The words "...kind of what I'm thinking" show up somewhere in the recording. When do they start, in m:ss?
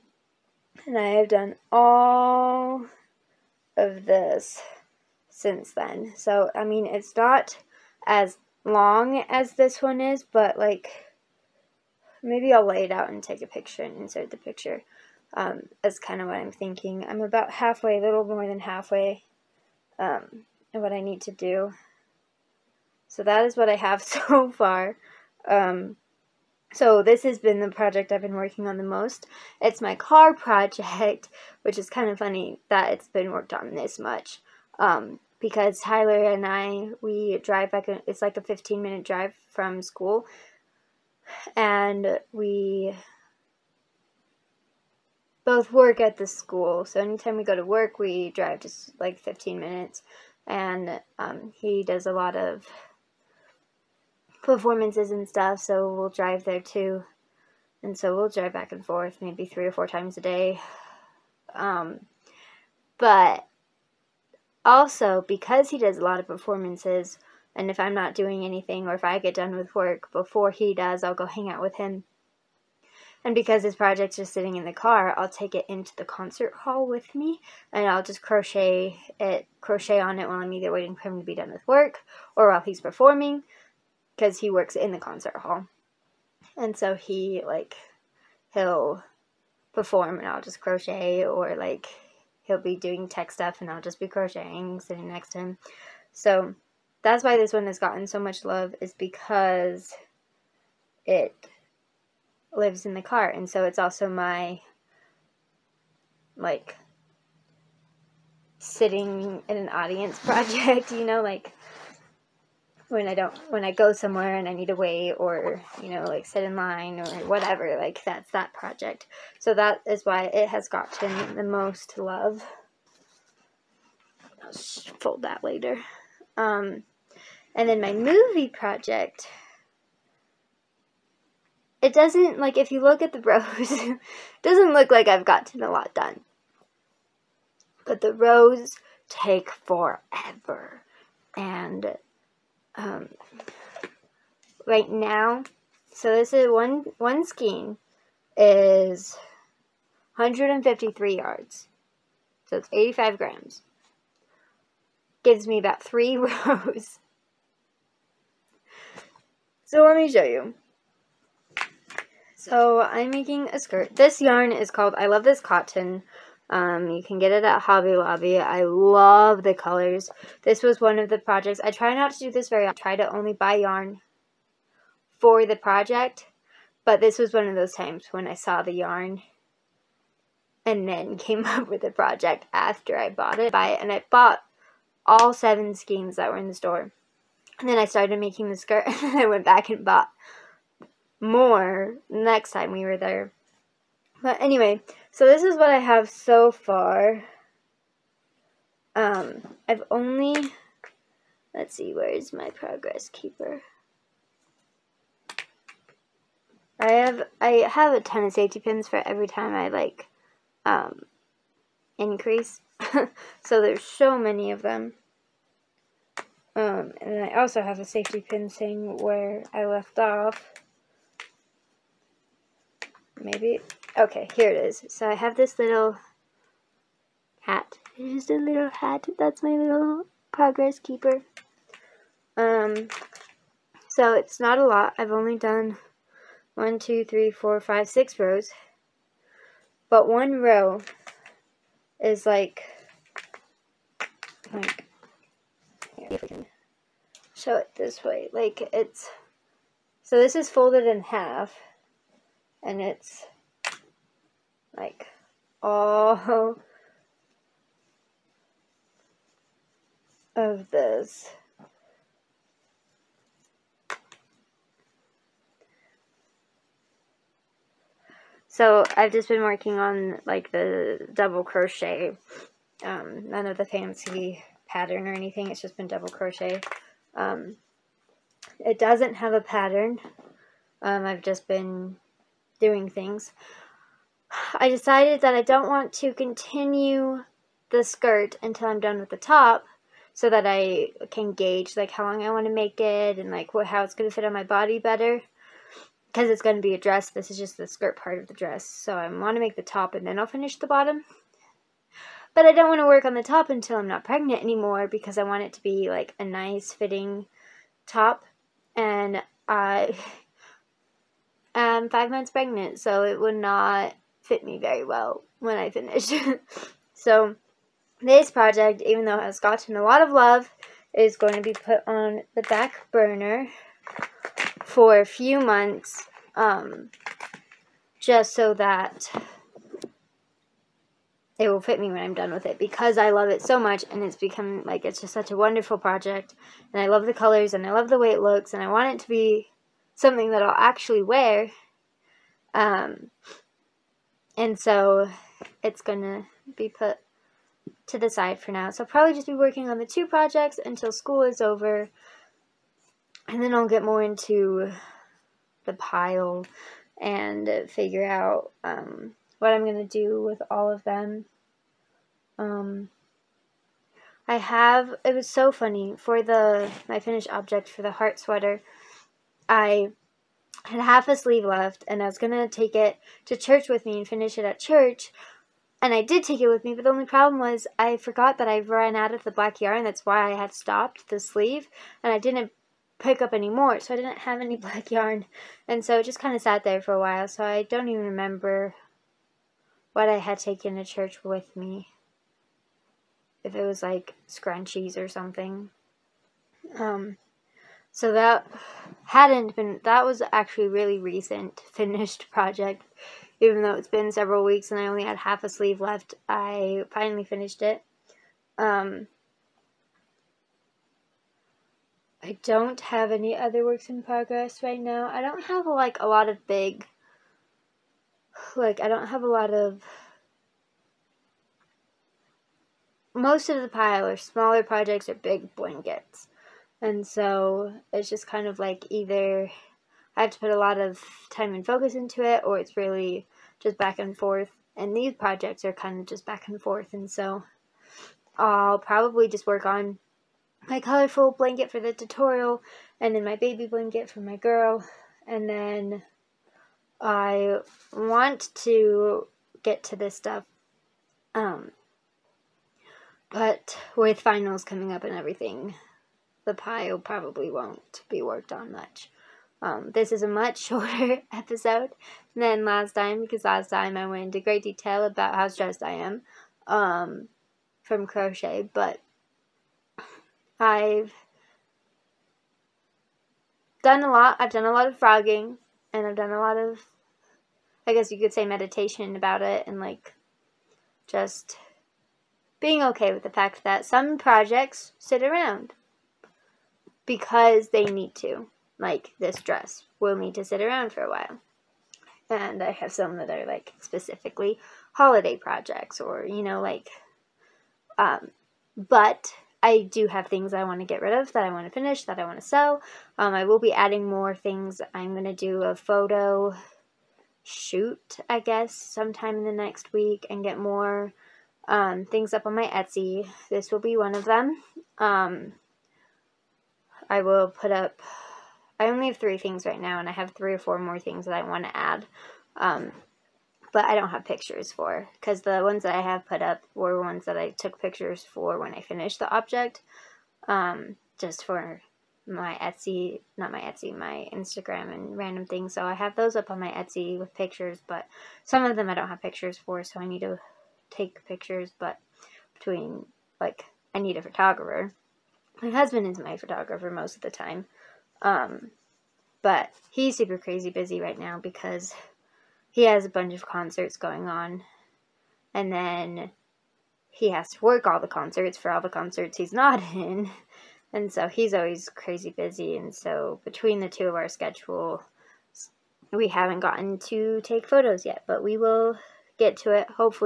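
0:15.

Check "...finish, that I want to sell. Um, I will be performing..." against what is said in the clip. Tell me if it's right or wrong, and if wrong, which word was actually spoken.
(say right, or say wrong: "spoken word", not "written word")
wrong: "adding", not "performing".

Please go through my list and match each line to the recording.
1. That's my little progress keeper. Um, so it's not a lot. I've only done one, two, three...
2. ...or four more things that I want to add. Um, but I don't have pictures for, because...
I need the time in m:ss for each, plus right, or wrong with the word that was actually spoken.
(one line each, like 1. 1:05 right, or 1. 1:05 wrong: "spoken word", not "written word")
1. 3:49 right
2. 8:40 right.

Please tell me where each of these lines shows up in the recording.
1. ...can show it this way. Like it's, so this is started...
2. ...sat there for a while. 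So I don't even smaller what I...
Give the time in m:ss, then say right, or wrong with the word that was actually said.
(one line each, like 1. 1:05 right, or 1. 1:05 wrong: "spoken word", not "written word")
1. 4:06 wrong: "folded", not "started"
2. 6:26 wrong: "remember", not "smaller".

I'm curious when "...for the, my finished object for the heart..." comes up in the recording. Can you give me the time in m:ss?
6:05.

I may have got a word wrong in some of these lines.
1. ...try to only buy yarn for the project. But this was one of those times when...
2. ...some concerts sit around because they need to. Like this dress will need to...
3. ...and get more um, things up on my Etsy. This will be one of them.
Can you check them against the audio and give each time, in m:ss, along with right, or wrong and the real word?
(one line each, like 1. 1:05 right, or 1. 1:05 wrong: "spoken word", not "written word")
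1. 2:52 right
2. 8:03 wrong: "projects", not "concerts"
3. 8:30 right.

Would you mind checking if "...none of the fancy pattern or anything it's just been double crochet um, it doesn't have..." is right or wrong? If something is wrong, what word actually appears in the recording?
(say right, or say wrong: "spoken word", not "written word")
right.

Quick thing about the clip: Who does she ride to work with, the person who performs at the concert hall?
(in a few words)
Tyler.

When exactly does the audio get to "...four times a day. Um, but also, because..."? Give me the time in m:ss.
0:59.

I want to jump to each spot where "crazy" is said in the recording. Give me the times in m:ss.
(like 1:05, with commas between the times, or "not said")
9:10, 9:21.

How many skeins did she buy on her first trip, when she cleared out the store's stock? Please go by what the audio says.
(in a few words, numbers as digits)
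7.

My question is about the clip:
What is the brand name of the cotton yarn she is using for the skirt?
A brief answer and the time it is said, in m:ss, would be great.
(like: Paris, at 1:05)
I Love This Cotton, at 2:44.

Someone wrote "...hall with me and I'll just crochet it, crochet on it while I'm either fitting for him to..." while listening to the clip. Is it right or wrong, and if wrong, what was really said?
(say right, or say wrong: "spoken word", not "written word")
wrong: "waiting", not "fitting".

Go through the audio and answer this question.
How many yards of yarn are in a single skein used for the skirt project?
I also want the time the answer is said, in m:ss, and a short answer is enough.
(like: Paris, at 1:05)
153, at 2:30.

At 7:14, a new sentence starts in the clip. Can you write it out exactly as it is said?
And these projects are kind of just back and forth.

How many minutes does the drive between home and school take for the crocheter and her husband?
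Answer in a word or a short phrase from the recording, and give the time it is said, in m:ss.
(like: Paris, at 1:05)
15, at 0:38.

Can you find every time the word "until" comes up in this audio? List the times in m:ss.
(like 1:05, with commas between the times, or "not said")
4:48, 5:03, 5:50.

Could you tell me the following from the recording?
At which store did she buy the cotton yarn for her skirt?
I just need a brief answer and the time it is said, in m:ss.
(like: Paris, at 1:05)
Hobby Lobby, at 2:47.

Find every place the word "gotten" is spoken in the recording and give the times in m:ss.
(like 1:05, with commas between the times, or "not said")
1:37, 2:00, 2:15, 5:19, 9:26.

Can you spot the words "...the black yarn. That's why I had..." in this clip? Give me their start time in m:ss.
6:19.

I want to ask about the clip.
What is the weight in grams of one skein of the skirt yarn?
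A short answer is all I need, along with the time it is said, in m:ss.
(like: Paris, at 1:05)
85, at 2:32.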